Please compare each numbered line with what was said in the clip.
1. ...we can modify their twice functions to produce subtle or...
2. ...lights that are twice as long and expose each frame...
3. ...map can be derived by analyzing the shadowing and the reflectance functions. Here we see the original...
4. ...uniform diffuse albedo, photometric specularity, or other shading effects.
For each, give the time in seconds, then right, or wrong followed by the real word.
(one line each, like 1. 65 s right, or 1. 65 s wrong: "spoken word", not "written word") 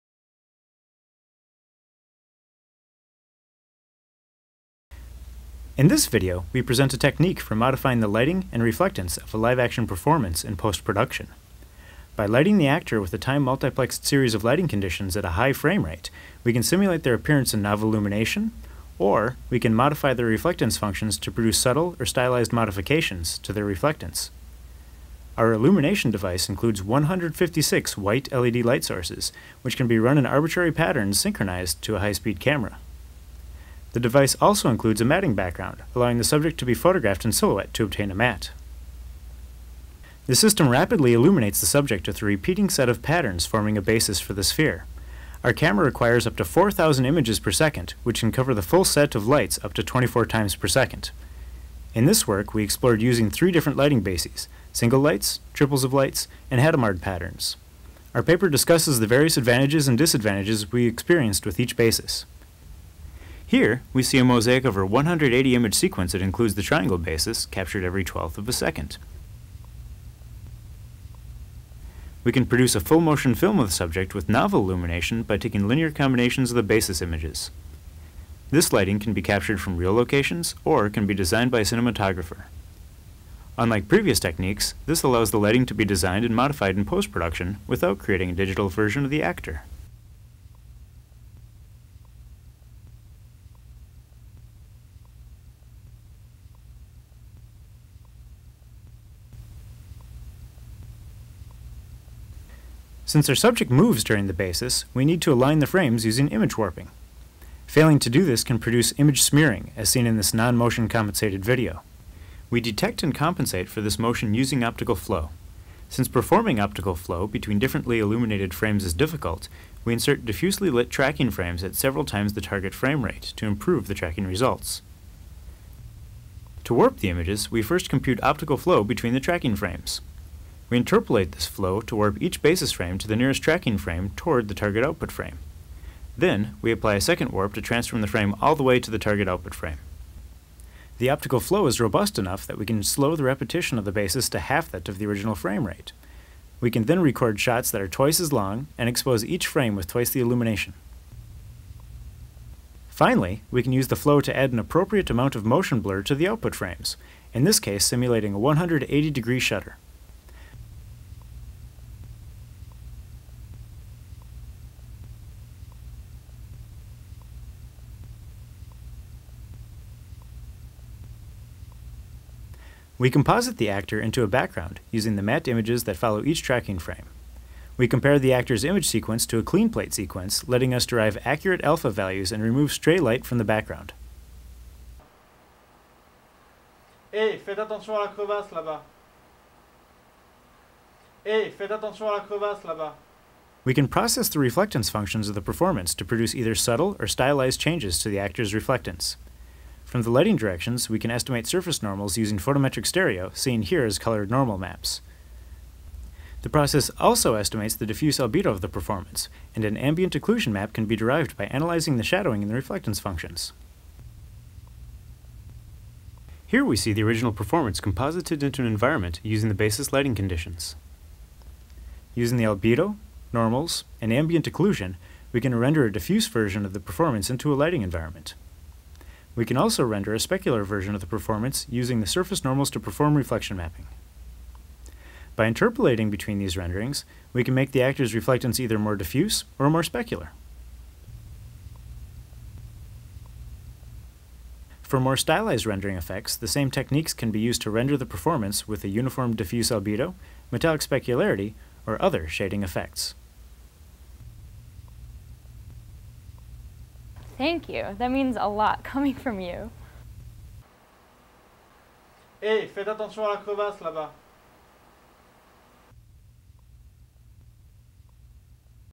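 1. 19 s wrong: "reflectance", not "twice"
2. 147 s wrong: "shots", not "lights"
3. 210 s right
4. 248 s wrong: "metallic", not "photometric".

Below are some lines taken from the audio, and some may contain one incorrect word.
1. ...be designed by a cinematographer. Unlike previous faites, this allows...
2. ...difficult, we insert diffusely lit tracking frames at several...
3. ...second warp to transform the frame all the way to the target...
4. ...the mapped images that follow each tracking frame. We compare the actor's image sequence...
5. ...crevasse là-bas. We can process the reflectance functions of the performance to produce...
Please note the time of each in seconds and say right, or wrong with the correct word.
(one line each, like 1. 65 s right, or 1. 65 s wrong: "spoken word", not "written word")
1. 81 s wrong: "techniques", not "faites"
2. 118 s right
3. 137 s right
4. 175 s right
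5. 192 s right.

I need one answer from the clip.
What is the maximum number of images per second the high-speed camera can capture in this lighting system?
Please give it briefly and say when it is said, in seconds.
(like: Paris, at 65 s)
4,000, at 46 s.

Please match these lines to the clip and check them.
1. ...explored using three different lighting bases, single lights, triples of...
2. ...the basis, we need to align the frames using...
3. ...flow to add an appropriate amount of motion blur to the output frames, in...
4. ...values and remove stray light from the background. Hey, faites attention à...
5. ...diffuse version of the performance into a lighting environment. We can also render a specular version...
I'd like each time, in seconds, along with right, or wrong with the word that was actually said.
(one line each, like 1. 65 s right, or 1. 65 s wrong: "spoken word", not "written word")
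1. 52 s right
2. 104 s right
3. 153 s right
4. 181 s right
5. 225 s right.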